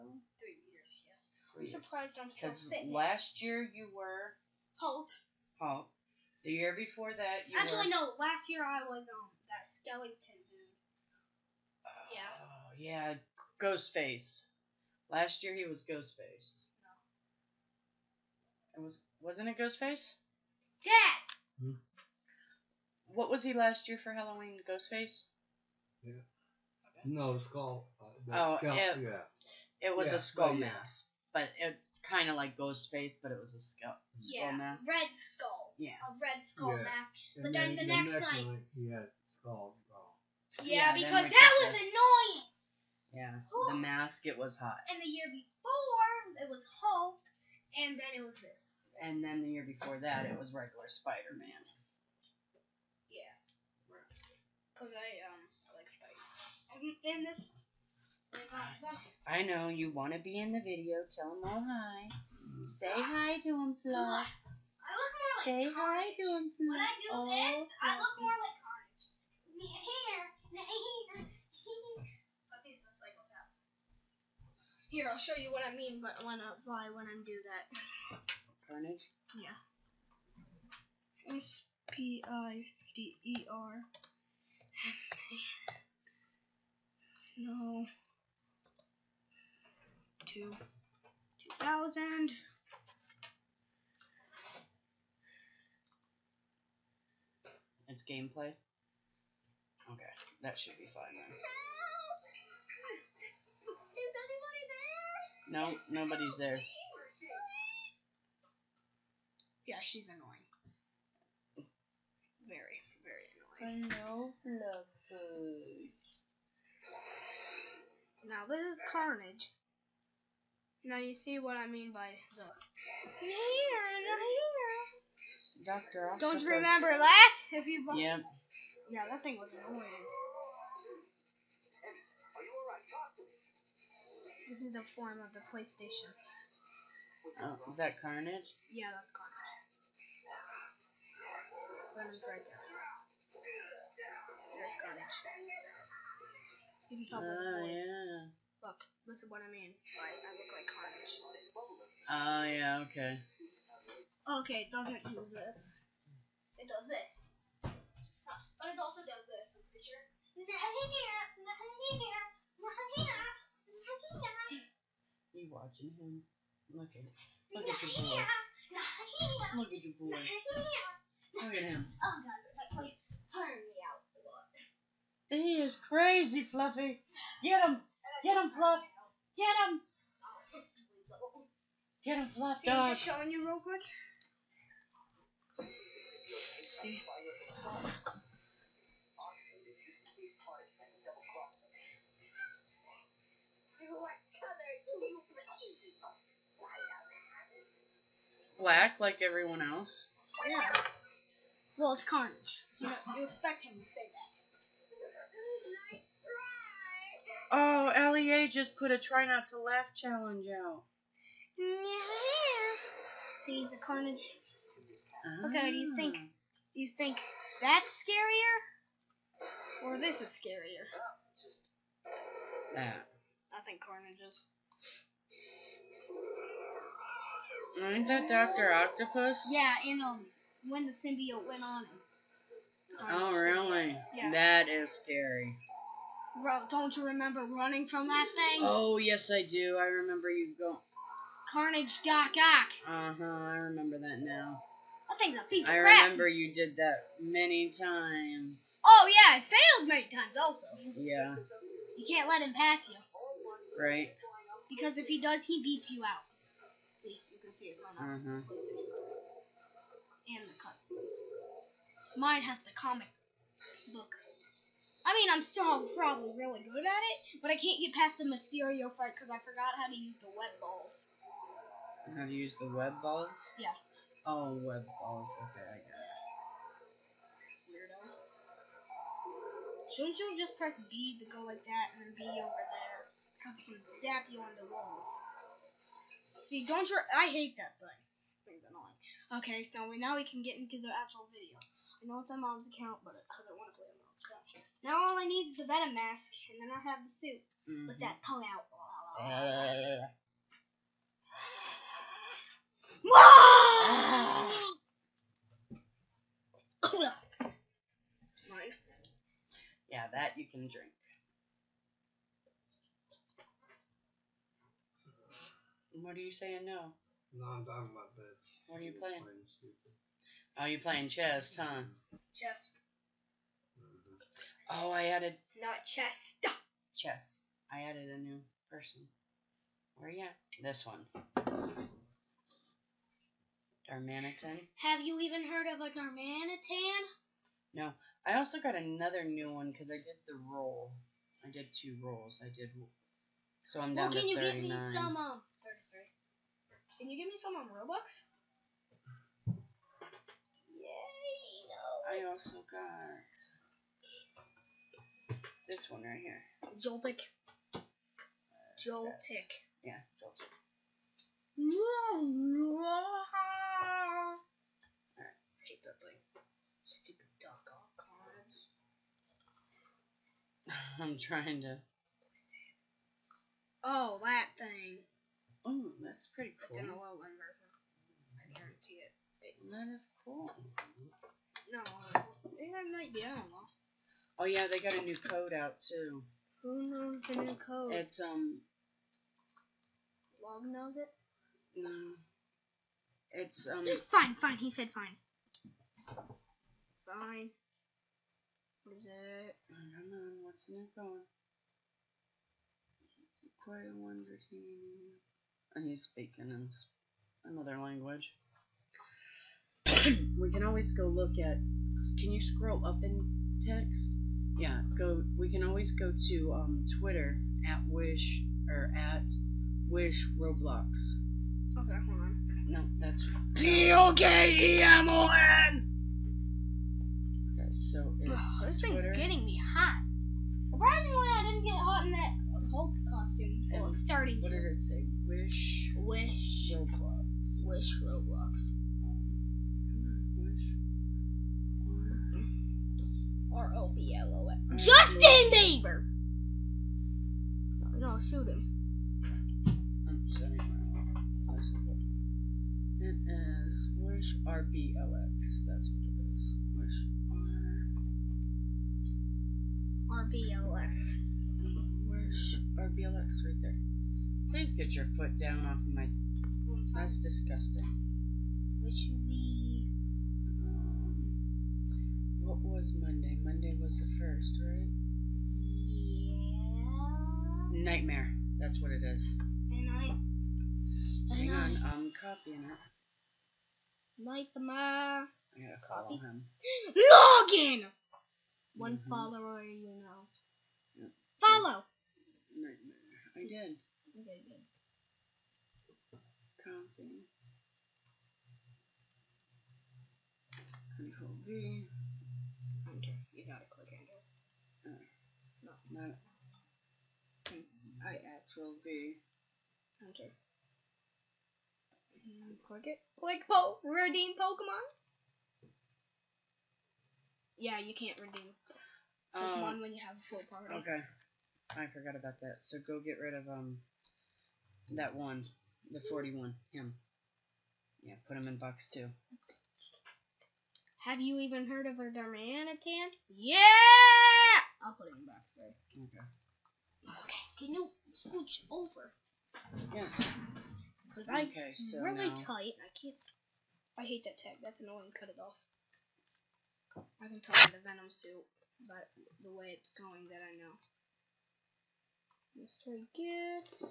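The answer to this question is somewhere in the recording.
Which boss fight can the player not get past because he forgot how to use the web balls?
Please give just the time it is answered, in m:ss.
4:28.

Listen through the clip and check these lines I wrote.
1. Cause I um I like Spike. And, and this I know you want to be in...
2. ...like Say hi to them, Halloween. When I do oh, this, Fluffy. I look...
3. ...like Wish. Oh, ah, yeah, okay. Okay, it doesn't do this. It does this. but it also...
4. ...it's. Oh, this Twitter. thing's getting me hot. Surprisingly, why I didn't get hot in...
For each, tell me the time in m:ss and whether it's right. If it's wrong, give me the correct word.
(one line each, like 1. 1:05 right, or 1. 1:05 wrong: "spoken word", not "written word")
1. 0:54 right
2. 1:05 wrong: "Flo", not "Halloween"
3. 2:30 wrong: "Hans", not "Wish"
4. 7:08 right.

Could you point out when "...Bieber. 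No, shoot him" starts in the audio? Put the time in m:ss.
7:25.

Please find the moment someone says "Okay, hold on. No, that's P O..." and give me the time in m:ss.
7:01.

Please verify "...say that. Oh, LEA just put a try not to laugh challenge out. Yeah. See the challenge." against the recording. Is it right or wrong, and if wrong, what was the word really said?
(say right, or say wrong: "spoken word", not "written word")
wrong: "carnage", not "challenge".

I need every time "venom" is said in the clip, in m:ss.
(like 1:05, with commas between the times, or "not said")
4:55, 9:07.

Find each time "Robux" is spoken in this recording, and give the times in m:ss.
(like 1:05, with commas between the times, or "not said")
5:47.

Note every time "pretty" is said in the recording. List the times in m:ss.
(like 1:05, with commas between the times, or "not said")
2:39, 6:16.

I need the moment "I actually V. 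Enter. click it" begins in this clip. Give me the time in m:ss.
8:28.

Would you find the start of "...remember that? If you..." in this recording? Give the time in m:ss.
2:06.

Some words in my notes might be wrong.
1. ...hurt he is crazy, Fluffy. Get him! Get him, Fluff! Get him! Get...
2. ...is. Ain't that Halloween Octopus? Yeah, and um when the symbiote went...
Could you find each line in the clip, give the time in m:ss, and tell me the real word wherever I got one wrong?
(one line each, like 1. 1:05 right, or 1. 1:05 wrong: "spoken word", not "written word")
1. 2:53 right
2. 3:44 wrong: "Doctor", not "Halloween".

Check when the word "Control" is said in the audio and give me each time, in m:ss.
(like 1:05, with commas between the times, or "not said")
8:20.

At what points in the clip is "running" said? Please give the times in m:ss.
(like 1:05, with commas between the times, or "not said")
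3:57.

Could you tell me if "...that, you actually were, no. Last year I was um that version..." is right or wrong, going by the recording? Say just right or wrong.
wrong.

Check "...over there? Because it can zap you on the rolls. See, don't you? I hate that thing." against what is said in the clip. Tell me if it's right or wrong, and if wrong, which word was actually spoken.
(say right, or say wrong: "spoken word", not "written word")
wrong: "walls", not "rolls".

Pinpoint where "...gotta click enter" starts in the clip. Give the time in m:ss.
8:23.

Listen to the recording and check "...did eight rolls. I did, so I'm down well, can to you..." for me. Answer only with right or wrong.
wrong.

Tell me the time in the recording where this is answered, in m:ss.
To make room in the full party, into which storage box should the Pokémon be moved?
8:48.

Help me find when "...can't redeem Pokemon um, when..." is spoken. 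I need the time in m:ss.
8:37.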